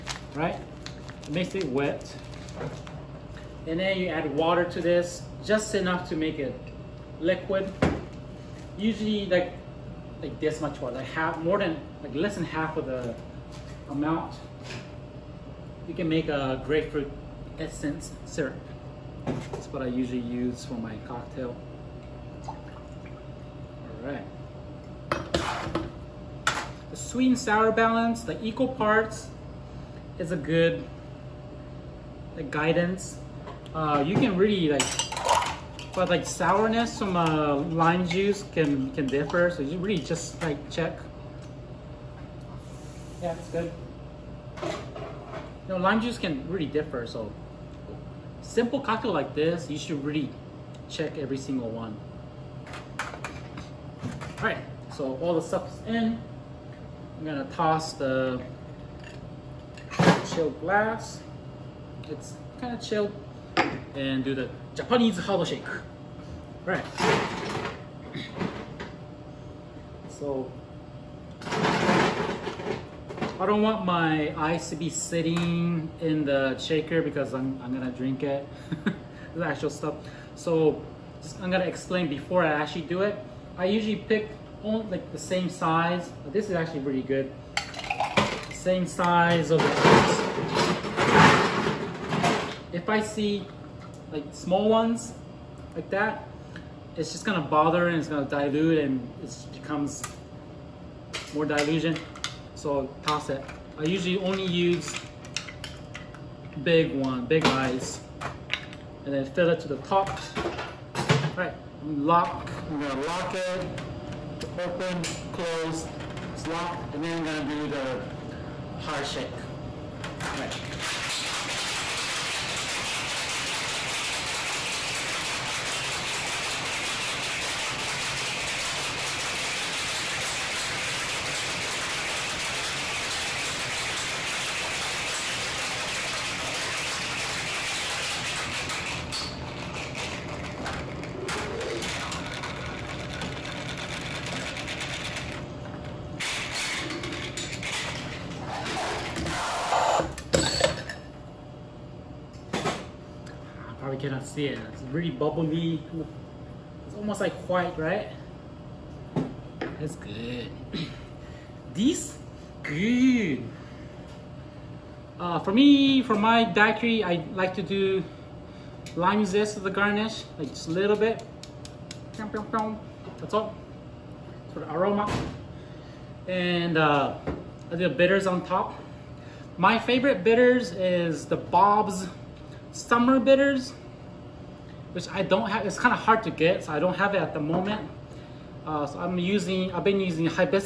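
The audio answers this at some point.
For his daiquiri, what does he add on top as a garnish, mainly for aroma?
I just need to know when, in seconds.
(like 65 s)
168 s.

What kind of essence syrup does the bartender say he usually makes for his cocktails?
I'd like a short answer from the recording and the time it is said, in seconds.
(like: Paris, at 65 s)
grapefruit, at 16 s.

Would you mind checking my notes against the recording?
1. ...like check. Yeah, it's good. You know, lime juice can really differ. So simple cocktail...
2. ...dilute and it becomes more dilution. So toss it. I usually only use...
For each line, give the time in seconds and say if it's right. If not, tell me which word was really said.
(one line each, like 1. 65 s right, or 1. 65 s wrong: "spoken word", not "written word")
1. 40 s right
2. 98 s right.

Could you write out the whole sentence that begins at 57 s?
I'm gonna toss the chilled glass.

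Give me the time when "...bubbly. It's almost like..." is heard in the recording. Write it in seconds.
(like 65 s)
155 s.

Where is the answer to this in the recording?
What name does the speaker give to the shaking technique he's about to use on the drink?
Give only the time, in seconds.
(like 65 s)
64 s.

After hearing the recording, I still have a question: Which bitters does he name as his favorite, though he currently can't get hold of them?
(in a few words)
Bob's Summer Bitters.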